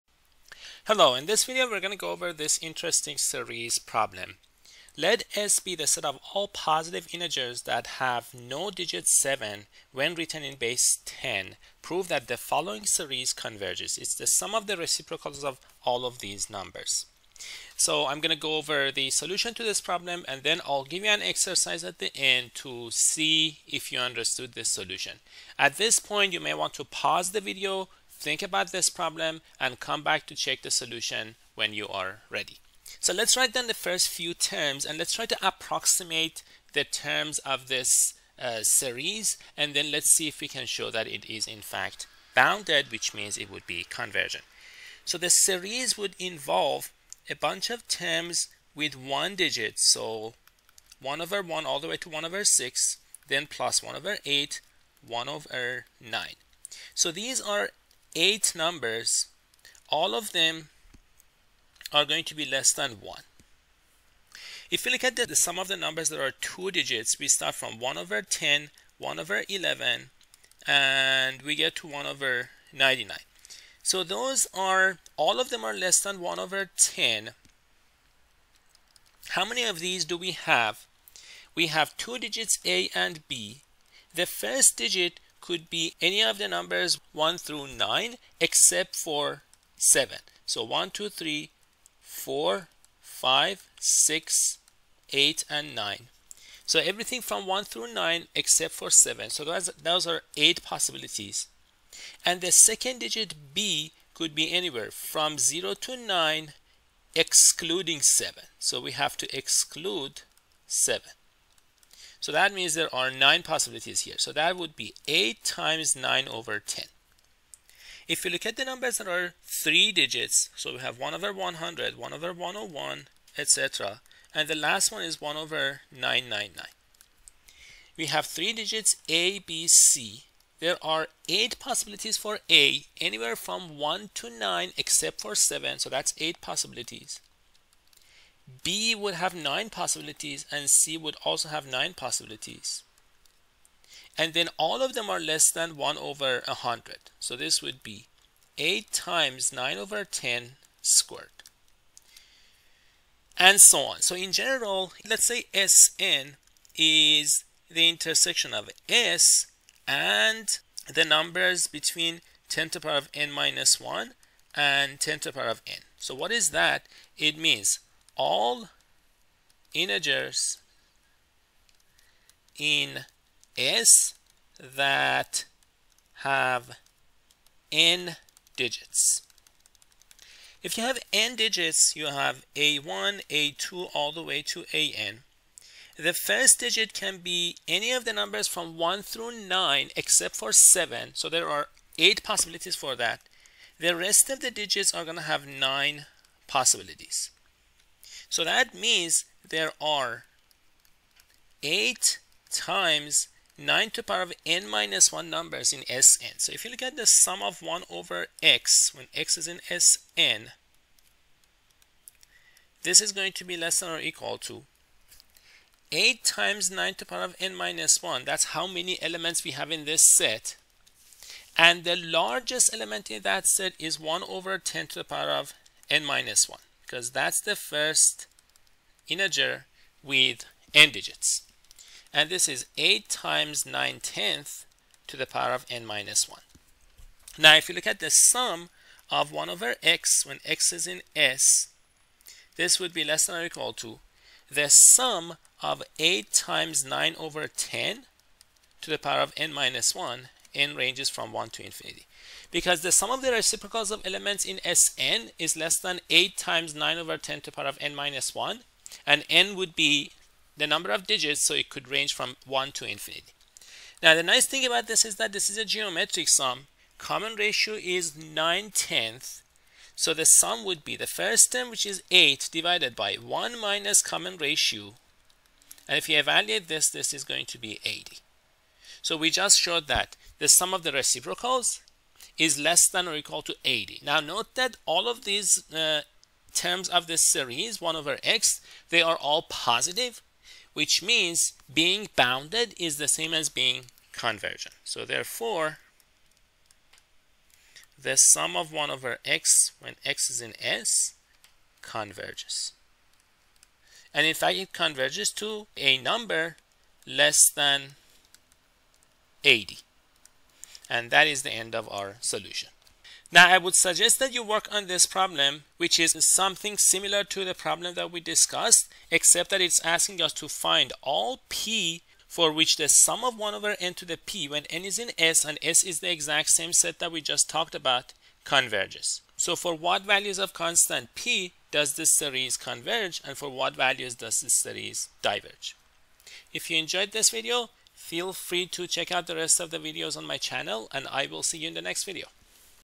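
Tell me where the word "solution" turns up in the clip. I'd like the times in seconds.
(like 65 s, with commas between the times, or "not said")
19 s, 24 s, 30 s, 312 s.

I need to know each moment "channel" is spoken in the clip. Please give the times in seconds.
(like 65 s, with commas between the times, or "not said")
340 s.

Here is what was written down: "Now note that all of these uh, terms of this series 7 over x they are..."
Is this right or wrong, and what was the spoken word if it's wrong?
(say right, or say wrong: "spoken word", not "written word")
wrong: "1", not "7".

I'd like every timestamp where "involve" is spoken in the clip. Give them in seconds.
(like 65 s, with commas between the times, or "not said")
46 s.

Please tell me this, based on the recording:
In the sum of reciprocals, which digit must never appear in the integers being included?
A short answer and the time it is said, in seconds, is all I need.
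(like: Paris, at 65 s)
7, at 8 s.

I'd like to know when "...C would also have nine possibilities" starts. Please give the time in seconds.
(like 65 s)
140 s.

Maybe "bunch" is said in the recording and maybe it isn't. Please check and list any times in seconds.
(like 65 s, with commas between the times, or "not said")
47 s.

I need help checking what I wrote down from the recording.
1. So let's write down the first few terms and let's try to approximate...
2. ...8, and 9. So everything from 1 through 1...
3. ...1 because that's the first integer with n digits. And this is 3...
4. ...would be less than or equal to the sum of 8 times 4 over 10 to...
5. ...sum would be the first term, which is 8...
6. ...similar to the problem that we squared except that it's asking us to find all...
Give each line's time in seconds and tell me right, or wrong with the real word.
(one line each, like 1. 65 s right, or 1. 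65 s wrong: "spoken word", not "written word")
1. 32 s right
2. 95 s wrong: "9", not "1"
3. 226 s wrong: "8", not "3"
4. 242 s wrong: "9", not "4"
5. 270 s right
6. 316 s wrong: "discussed", not "squared".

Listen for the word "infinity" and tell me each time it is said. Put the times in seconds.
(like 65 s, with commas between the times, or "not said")
251 s, 262 s.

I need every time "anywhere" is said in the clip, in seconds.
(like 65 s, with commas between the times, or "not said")
104 s, 132 s.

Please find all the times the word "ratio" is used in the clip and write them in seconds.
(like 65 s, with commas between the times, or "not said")
267 s, 274 s.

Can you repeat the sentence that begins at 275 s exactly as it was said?
And if you evaluate this, this is going to be 80.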